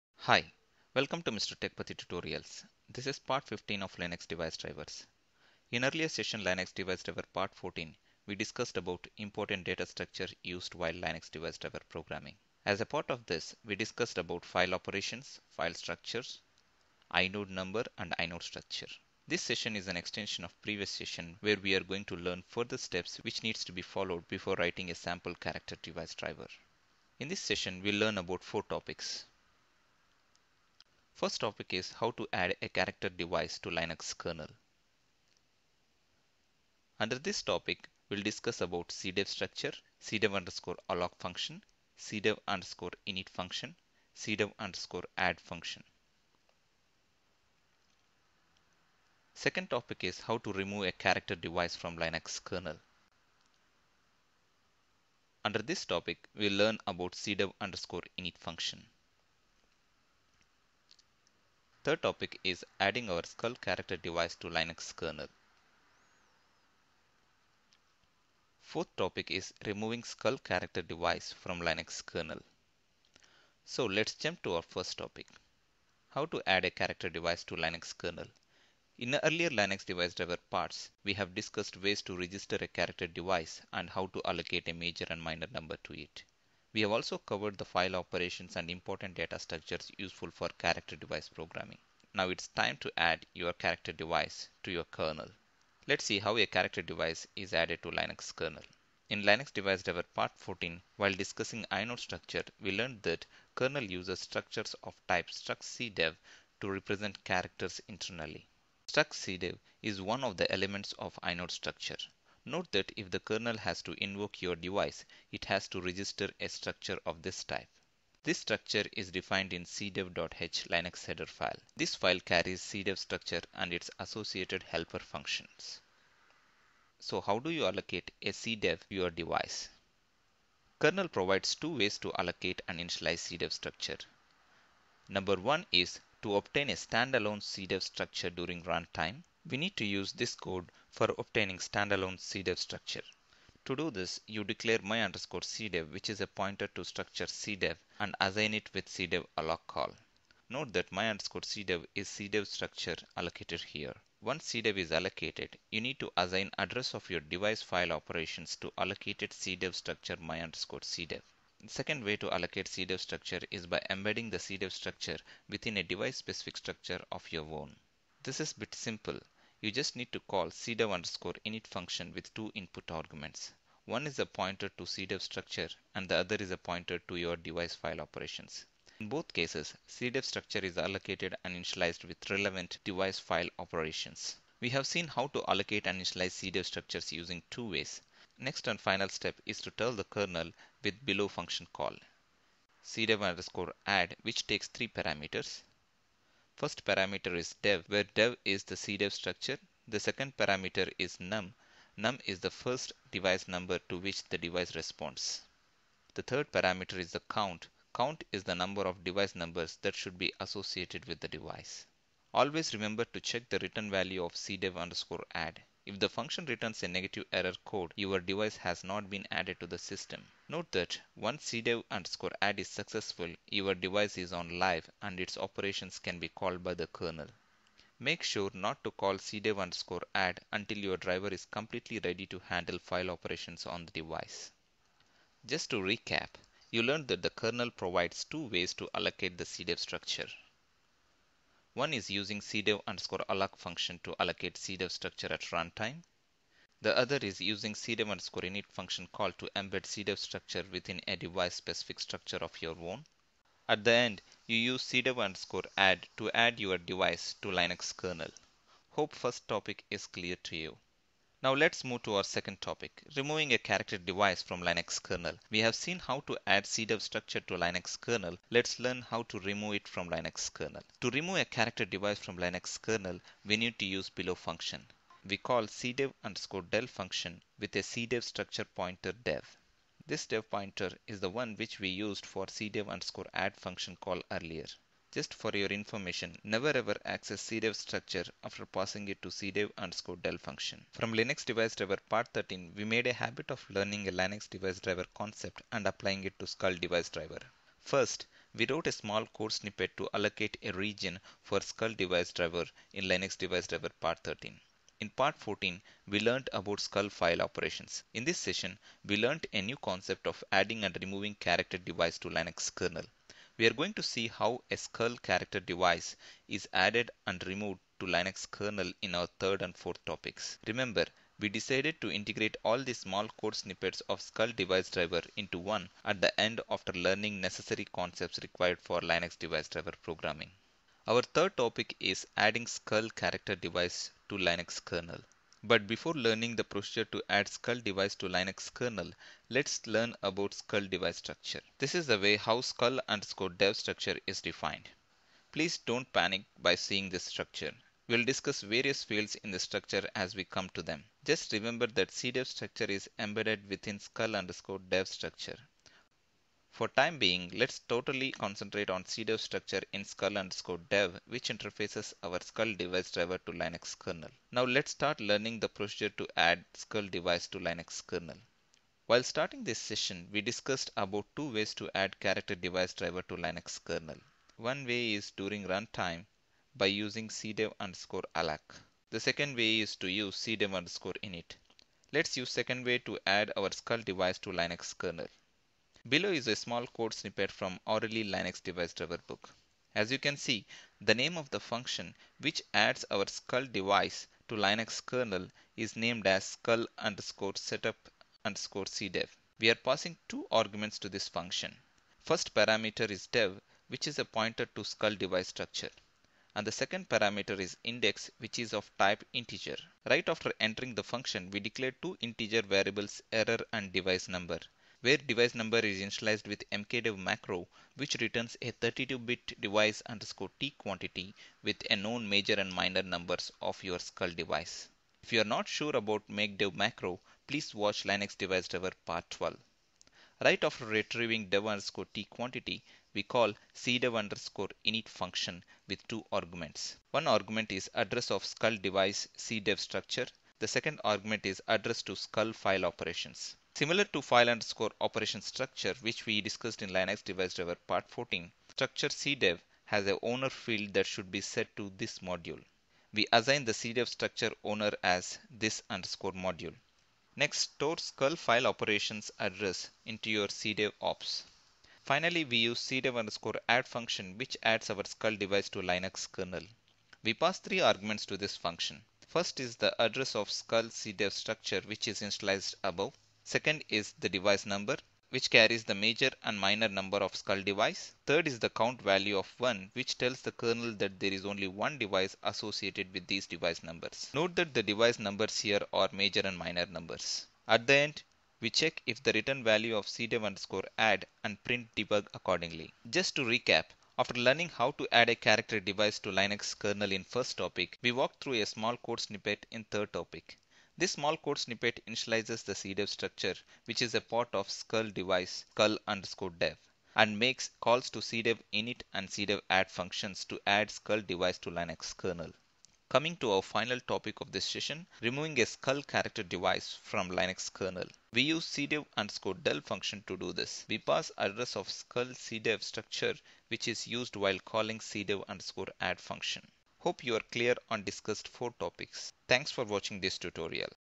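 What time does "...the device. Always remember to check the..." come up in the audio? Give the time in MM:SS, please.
03:31.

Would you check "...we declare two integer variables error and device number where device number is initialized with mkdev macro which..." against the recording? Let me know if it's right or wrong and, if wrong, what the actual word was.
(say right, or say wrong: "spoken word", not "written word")
right.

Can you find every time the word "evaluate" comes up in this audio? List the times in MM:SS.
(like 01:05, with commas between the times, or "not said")
not said.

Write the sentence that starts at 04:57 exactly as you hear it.
First, we wrote a small code snippet to allocate a region for scull device driver in Linux device driver part 13.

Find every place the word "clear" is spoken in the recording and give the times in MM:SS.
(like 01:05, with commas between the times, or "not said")
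04:20, 08:47.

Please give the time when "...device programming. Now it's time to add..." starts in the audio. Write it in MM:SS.
01:30.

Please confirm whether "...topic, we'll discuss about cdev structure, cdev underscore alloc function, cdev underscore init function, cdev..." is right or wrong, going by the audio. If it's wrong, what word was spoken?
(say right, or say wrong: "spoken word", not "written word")
right.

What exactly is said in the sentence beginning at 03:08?
Next and final step is to tell the kernel with below function call.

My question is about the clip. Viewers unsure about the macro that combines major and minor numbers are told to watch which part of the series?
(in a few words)
Part 12.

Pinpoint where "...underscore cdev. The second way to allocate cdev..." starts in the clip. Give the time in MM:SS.
02:40.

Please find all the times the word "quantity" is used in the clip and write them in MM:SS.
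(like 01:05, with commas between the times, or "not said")
07:00, 07:12.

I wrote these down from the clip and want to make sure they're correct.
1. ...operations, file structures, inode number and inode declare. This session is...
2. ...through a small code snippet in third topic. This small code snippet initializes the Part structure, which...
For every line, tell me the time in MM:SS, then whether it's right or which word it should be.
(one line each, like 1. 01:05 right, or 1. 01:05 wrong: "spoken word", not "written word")
1. 00:14 wrong: "structure", not "declare"
2. 08:18 wrong: "CDEV", not "Part".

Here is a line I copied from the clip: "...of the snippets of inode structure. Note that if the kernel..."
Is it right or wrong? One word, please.
wrong.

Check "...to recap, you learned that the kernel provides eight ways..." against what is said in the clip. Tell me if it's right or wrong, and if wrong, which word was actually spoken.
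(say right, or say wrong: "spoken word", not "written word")
wrong: "two", not "eight".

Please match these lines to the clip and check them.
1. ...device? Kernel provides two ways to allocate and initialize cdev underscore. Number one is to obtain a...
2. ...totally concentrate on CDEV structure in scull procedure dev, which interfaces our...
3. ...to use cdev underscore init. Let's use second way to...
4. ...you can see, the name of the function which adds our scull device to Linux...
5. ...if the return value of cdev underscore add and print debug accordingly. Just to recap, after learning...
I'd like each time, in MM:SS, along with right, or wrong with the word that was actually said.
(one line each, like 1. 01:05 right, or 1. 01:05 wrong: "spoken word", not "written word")
1. 02:09 wrong: "structure", not "underscore"
2. 05:57 wrong: "underscore", not "procedure"
3. 06:19 right
4. 06:30 right
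5. 08:09 right.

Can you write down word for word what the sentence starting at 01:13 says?
So let's jump to our first topic.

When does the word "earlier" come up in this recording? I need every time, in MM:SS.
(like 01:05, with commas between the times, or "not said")
00:05, 01:19, 04:44.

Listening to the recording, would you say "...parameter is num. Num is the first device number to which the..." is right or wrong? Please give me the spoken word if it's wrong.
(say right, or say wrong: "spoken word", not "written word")
right.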